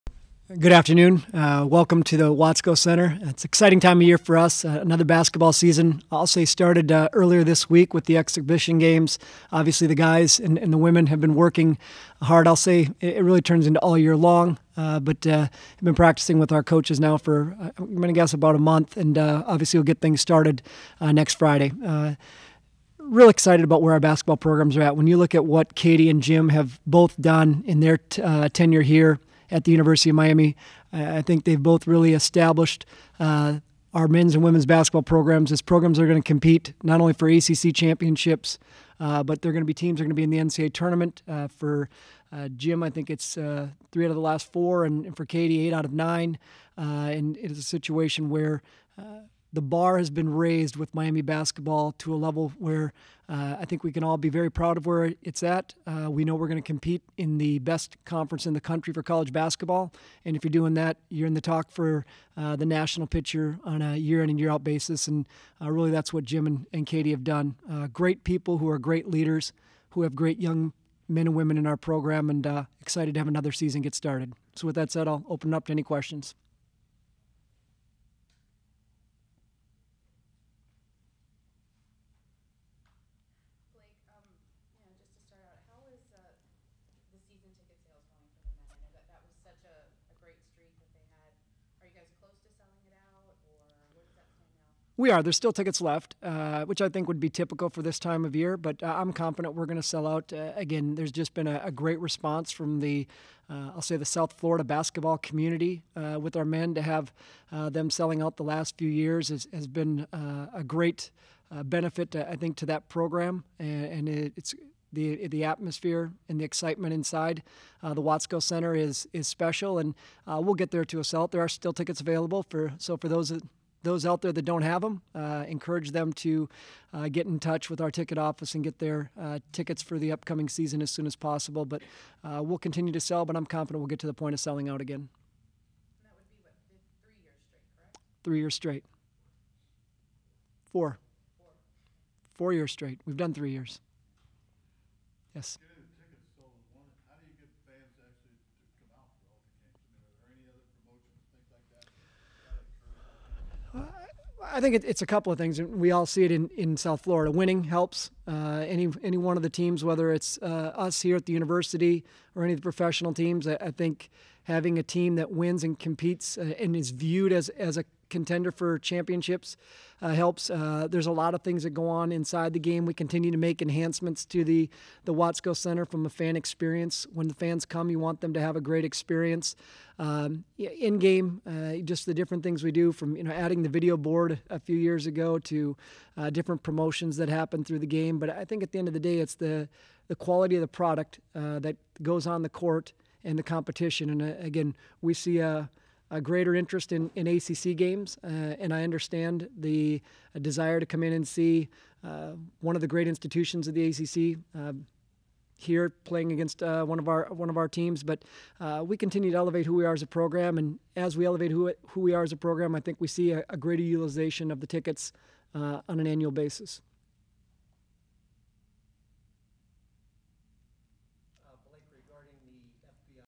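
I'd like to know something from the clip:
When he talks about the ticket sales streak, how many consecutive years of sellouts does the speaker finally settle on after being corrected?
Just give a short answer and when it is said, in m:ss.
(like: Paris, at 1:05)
4, at 2:22.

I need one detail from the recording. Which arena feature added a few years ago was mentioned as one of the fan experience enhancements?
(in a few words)
video board.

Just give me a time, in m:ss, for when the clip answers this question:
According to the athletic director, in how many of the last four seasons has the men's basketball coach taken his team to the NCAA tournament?
0:43.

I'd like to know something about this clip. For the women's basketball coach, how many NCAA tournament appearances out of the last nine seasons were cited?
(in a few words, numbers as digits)
8.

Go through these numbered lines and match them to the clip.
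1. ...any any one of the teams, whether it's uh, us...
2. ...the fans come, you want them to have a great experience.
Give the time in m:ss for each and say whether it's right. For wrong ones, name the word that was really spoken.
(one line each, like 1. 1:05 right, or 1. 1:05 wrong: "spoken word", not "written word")
1. 2:38 right
2. 2:57 right.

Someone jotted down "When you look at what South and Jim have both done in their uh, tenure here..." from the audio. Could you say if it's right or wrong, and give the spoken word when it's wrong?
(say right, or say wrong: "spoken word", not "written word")
wrong: "Katie", not "South".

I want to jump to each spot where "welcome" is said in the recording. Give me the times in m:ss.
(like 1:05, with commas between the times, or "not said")
0:01.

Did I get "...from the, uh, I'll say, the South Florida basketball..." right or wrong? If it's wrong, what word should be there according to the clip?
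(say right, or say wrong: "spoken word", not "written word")
right.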